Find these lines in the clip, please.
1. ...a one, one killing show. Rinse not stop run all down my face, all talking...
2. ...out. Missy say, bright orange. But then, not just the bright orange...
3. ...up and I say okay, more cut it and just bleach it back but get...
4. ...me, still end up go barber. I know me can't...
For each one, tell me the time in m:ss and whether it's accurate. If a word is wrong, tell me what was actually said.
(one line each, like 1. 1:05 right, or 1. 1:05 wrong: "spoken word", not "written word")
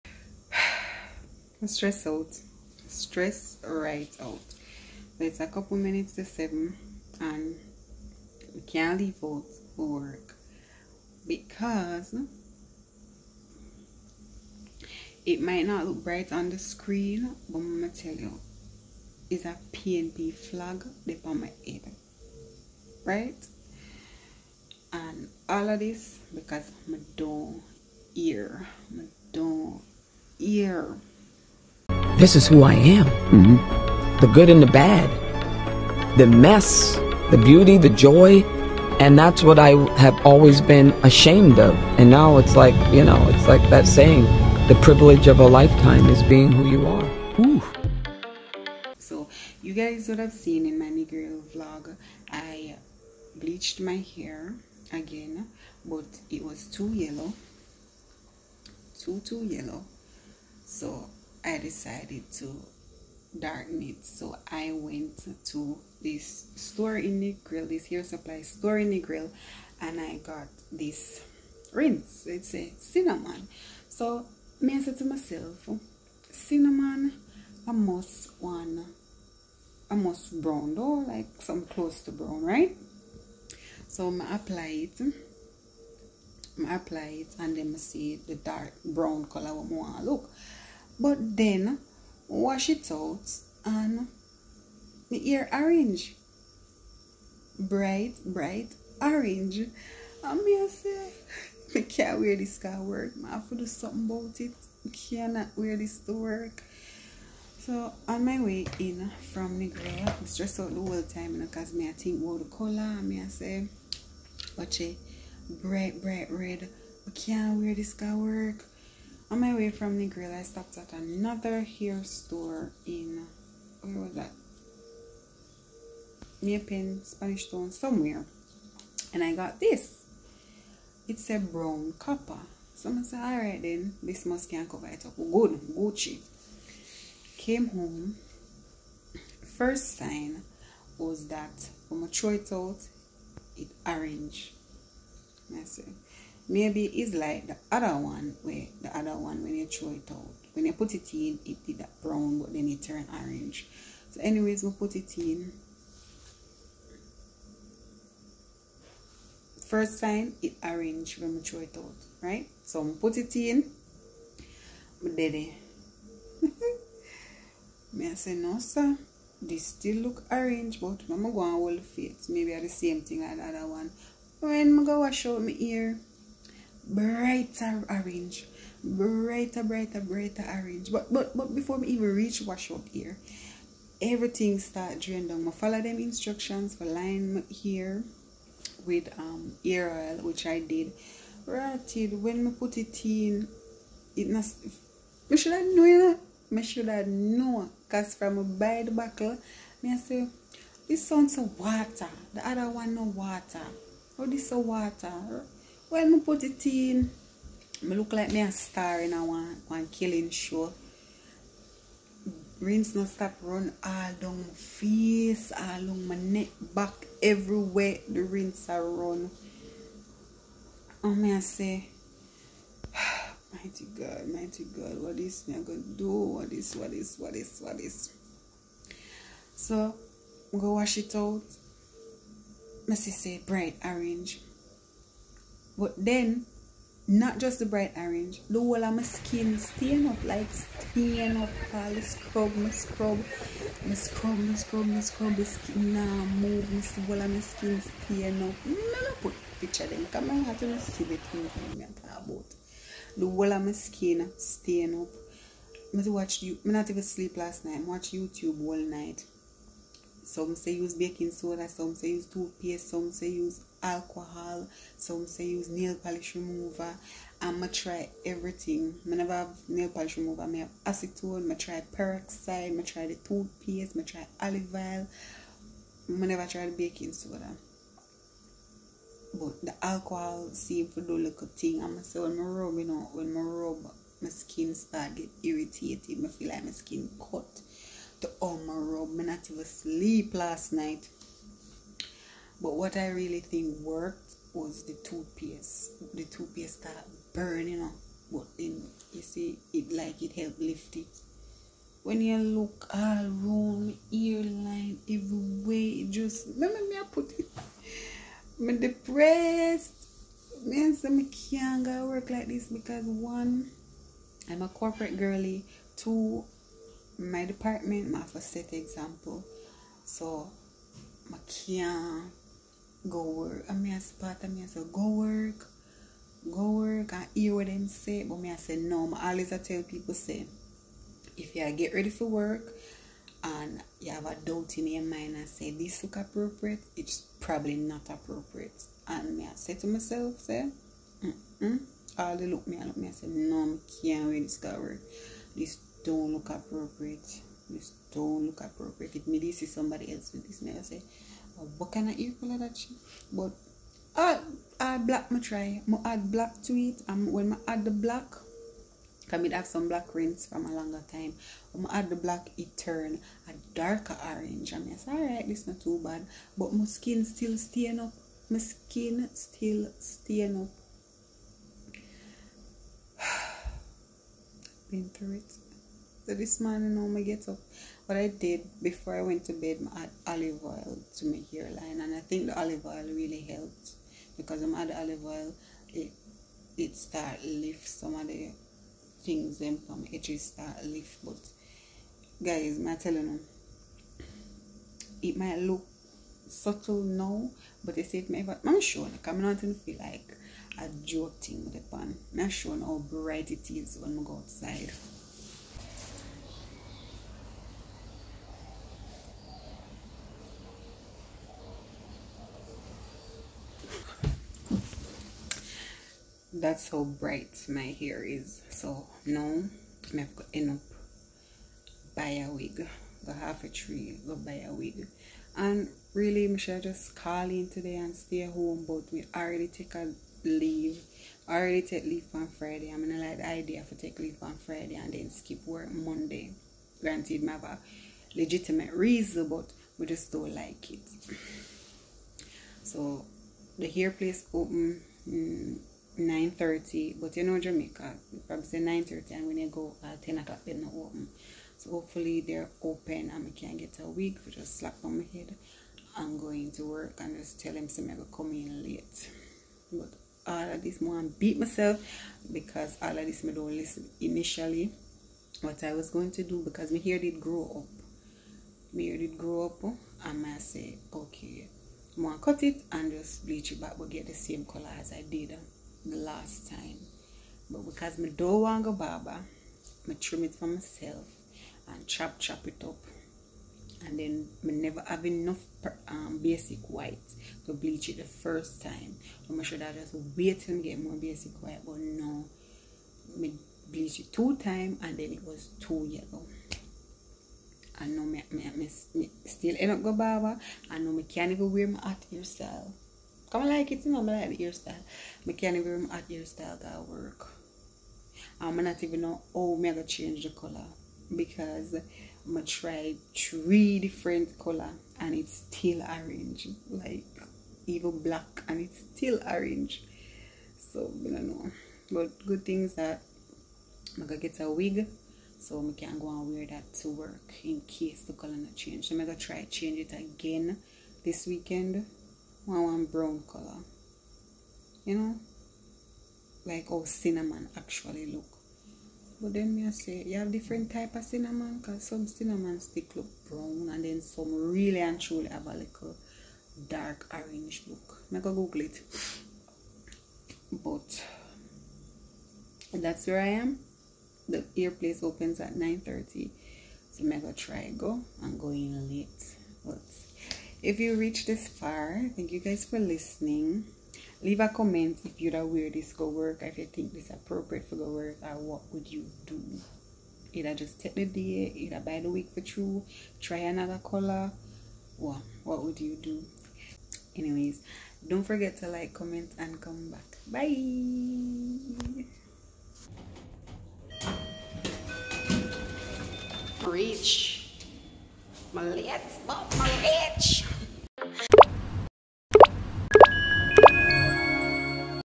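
1. 3:29 wrong: "along", not "talking"
2. 3:51 right
3. 7:49 right
4. 8:18 right.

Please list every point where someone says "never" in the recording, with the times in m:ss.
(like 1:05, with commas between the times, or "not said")
4:29, 4:36, 8:04.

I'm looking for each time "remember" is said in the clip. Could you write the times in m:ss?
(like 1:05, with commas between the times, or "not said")
5:06, 8:25.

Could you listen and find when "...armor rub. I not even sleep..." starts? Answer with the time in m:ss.
4:48.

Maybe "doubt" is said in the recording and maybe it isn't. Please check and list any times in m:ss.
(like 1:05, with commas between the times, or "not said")
5:34.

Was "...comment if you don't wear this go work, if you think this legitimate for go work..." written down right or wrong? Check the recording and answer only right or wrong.
wrong.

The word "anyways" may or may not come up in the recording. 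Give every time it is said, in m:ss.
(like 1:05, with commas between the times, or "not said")
2:34, 9:37.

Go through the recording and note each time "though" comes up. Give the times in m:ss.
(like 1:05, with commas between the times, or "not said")
1:20.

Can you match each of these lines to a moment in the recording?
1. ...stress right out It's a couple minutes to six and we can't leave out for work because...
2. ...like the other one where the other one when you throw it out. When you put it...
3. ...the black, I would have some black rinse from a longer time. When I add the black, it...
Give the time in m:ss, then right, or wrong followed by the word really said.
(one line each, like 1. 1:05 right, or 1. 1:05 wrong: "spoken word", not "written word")
1. 0:02 wrong: "seven", not "six"
2. 2:27 right
3. 5:57 right.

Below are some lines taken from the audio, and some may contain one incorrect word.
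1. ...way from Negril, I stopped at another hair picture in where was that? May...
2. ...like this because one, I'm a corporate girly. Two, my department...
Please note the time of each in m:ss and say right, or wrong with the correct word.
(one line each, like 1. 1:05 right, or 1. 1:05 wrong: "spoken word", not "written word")
1. 1:59 wrong: "store", not "picture"
2. 5:12 right.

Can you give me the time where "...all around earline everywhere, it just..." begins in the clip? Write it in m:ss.
5:02.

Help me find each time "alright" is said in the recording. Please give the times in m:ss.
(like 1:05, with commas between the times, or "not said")
2:13, 6:05.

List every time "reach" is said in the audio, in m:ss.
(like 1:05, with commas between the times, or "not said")
3:02, 9:21, 9:46.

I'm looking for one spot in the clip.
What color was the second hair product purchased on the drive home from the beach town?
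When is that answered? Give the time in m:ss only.
2:11.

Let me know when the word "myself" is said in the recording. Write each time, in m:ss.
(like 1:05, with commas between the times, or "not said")
1:15, 5:39, 7:41, 8:00.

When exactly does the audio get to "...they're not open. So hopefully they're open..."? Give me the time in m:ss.
7:30.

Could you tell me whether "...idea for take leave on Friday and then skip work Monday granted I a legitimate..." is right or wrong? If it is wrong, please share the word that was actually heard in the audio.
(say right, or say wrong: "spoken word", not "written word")
right.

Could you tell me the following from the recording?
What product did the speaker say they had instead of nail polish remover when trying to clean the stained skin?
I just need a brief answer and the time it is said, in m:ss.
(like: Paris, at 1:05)
Acetone, at 4:30.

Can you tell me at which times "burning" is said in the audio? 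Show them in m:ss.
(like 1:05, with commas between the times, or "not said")
4:57.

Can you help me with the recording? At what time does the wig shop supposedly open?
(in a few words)
9:30.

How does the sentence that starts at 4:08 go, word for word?
No, no, put picture them, come on, I have to see the things I'm talking about.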